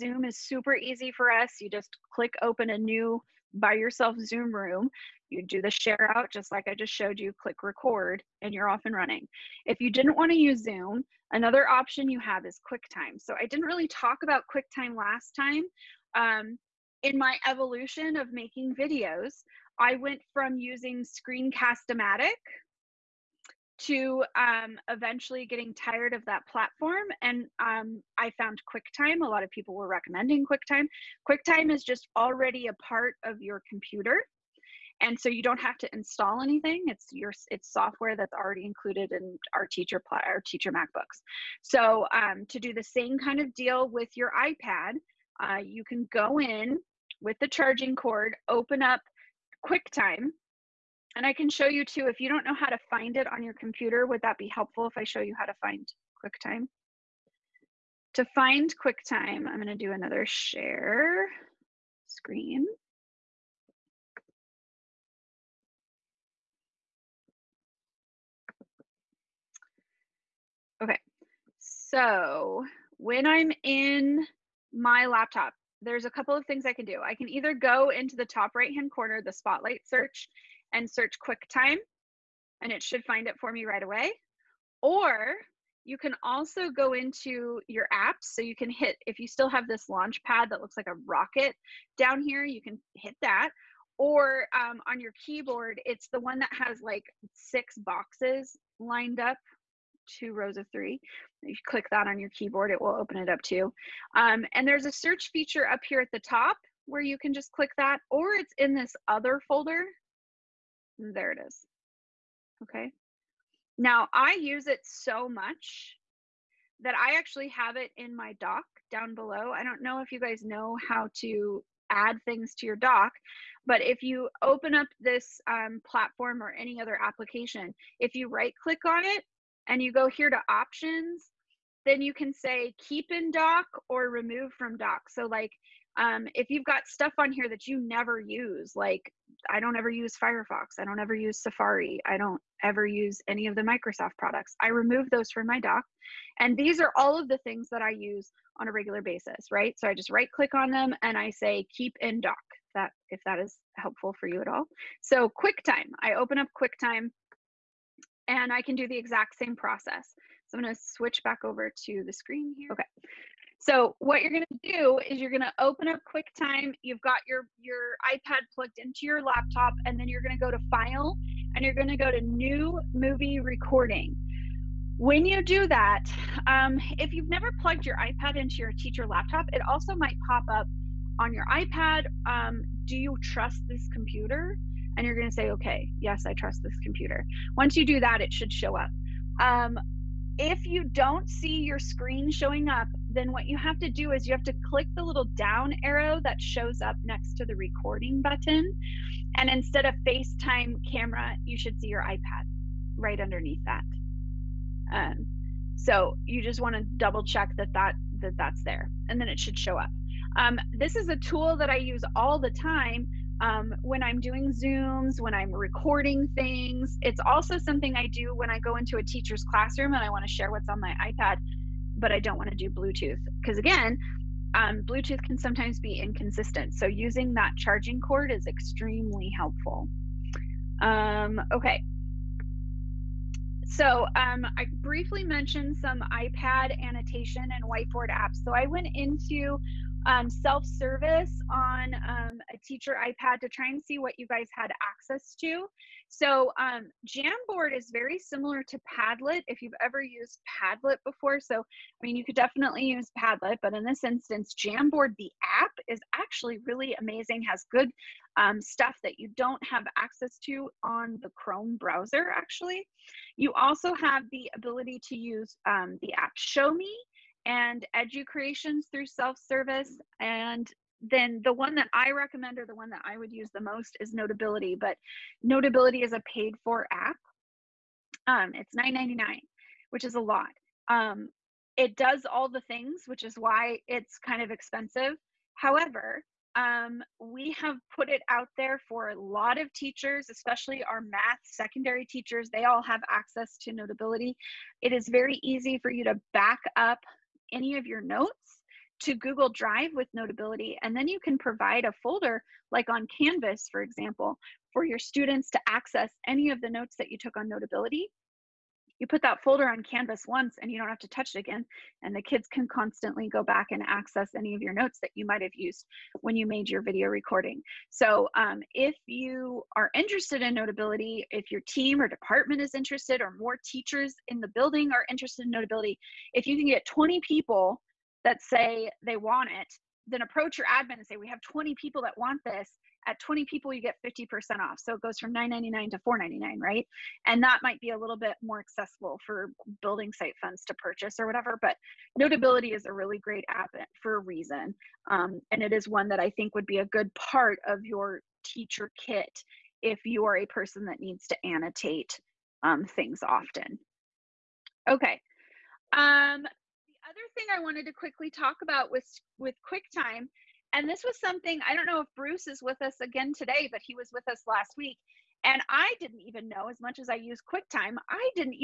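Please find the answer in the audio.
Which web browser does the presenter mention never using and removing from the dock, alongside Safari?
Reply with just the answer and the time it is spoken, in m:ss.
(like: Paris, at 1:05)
Firefox, at 2:20.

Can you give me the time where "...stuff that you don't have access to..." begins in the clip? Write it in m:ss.
4:18.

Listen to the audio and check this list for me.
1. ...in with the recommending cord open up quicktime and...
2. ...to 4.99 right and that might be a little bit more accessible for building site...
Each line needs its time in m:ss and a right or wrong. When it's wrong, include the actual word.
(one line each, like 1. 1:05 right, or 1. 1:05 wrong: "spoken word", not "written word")
1. 0:46 wrong: "charging", not "recommending"
2. 5:35 right.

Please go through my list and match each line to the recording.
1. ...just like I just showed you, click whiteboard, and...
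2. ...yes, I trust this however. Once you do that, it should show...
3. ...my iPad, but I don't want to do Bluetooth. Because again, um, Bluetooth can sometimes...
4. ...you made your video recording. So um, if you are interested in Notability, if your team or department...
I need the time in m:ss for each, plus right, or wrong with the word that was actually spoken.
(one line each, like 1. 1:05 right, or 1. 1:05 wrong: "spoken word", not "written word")
1. 0:06 wrong: "record", not "whiteboard"
2. 3:05 wrong: "computer", not "however"
3. 3:40 right
4. 5:16 right.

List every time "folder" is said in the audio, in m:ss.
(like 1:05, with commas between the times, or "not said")
1:49, 5:02, 5:09.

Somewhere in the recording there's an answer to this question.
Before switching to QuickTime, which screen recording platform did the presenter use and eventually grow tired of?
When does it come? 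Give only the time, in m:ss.
0:21.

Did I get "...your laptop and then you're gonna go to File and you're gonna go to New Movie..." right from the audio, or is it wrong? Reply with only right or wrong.
right.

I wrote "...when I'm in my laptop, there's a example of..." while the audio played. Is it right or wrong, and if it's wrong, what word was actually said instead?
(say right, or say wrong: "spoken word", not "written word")
wrong: "couple", not "example".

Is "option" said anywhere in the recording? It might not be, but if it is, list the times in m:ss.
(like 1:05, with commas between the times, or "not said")
0:11, 2:10.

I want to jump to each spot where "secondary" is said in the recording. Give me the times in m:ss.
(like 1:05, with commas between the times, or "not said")
4:51.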